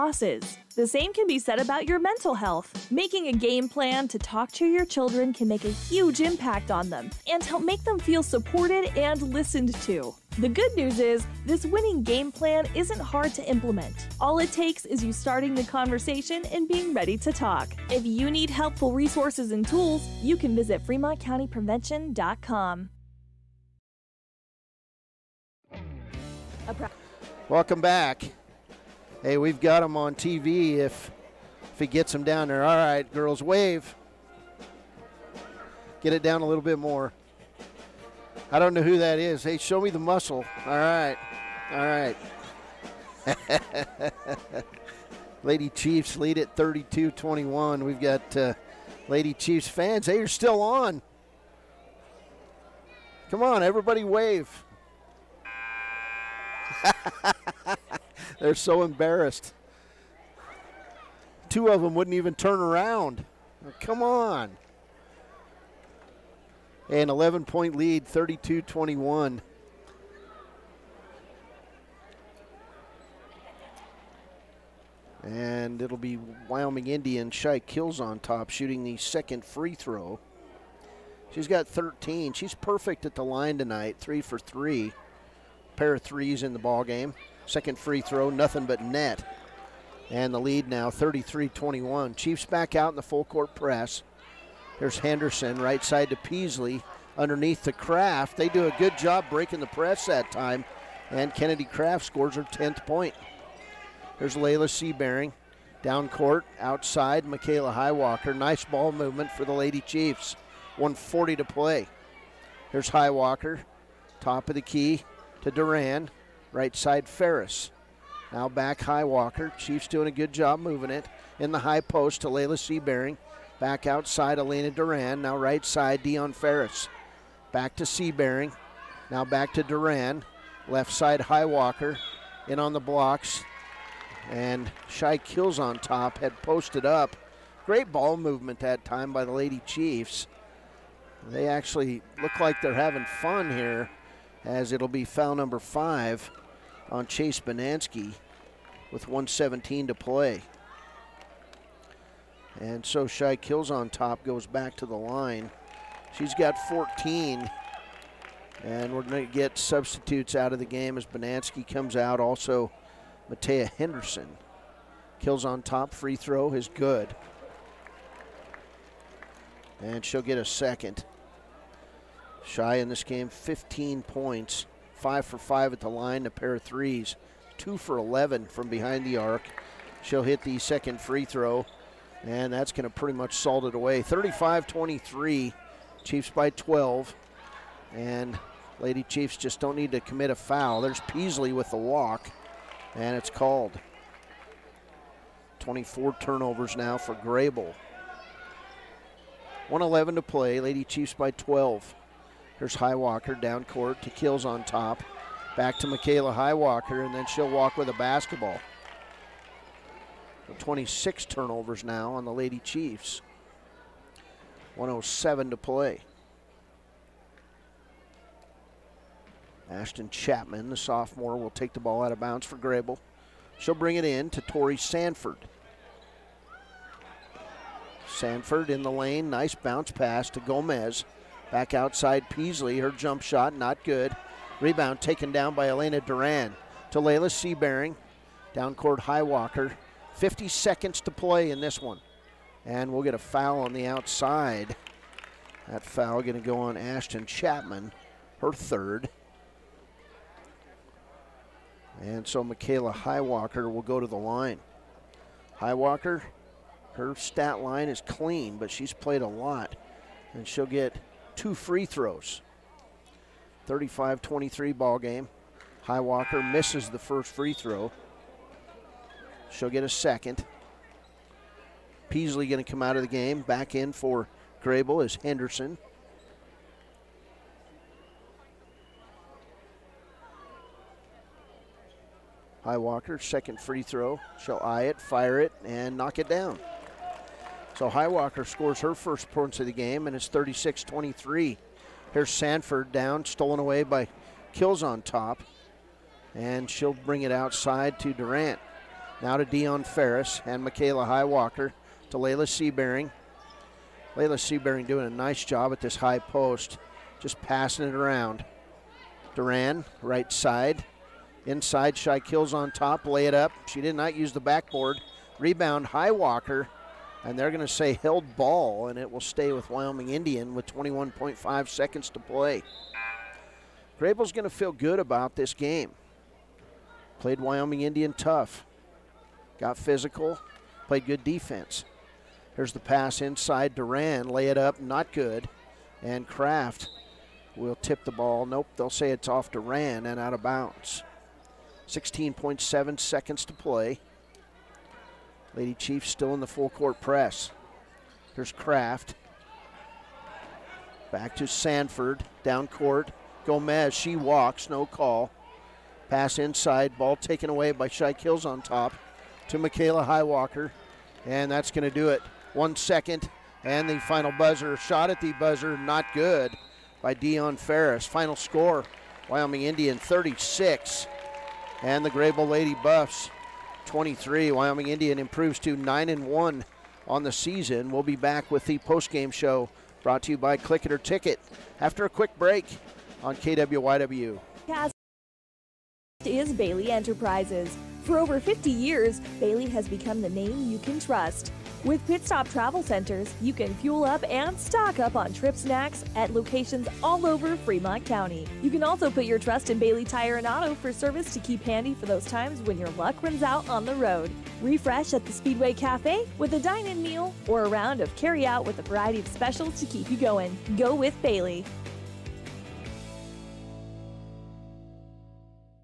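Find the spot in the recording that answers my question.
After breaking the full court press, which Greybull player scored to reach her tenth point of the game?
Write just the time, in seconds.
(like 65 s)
101 s.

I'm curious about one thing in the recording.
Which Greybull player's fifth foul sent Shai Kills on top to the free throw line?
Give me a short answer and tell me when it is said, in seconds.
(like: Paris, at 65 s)
Chase Banansky, at 147 s.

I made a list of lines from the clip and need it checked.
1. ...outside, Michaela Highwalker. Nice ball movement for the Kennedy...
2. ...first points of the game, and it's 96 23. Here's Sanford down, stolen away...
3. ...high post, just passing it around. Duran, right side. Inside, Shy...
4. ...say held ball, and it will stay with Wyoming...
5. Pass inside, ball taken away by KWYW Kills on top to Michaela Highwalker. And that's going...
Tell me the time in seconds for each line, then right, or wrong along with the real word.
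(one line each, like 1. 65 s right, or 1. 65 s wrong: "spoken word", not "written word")
1. 106 s wrong: "Lady", not "Kennedy"
2. 288 s wrong: "36", not "96"
3. 305 s right
4. 317 s right
5. 356 s wrong: "Shy", not "KWYW".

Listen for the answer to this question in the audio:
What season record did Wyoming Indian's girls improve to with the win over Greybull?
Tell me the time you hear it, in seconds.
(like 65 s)
375 s.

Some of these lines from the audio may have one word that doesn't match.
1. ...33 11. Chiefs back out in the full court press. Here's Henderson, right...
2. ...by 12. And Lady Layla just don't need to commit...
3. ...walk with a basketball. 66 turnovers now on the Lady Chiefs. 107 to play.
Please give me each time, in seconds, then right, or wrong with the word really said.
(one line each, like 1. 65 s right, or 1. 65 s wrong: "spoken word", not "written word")
1. 90 s wrong: "21", not "11"
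2. 186 s wrong: "Chiefs", not "Layla"
3. 207 s wrong: "26", not "66".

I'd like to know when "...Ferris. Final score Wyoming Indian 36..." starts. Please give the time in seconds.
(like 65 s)
367 s.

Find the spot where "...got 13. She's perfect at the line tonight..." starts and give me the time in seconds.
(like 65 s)
81 s.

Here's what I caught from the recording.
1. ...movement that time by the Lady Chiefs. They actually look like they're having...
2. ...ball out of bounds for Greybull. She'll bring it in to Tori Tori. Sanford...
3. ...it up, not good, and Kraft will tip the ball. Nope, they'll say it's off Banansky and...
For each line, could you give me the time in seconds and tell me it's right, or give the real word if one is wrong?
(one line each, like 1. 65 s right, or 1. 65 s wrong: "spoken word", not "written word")
1. 138 s right
2. 221 s wrong: "Sanford", not "Tori"
3. 334 s wrong: "Duran", not "Banansky".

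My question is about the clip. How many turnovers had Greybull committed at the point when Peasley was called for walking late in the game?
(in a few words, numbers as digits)
24.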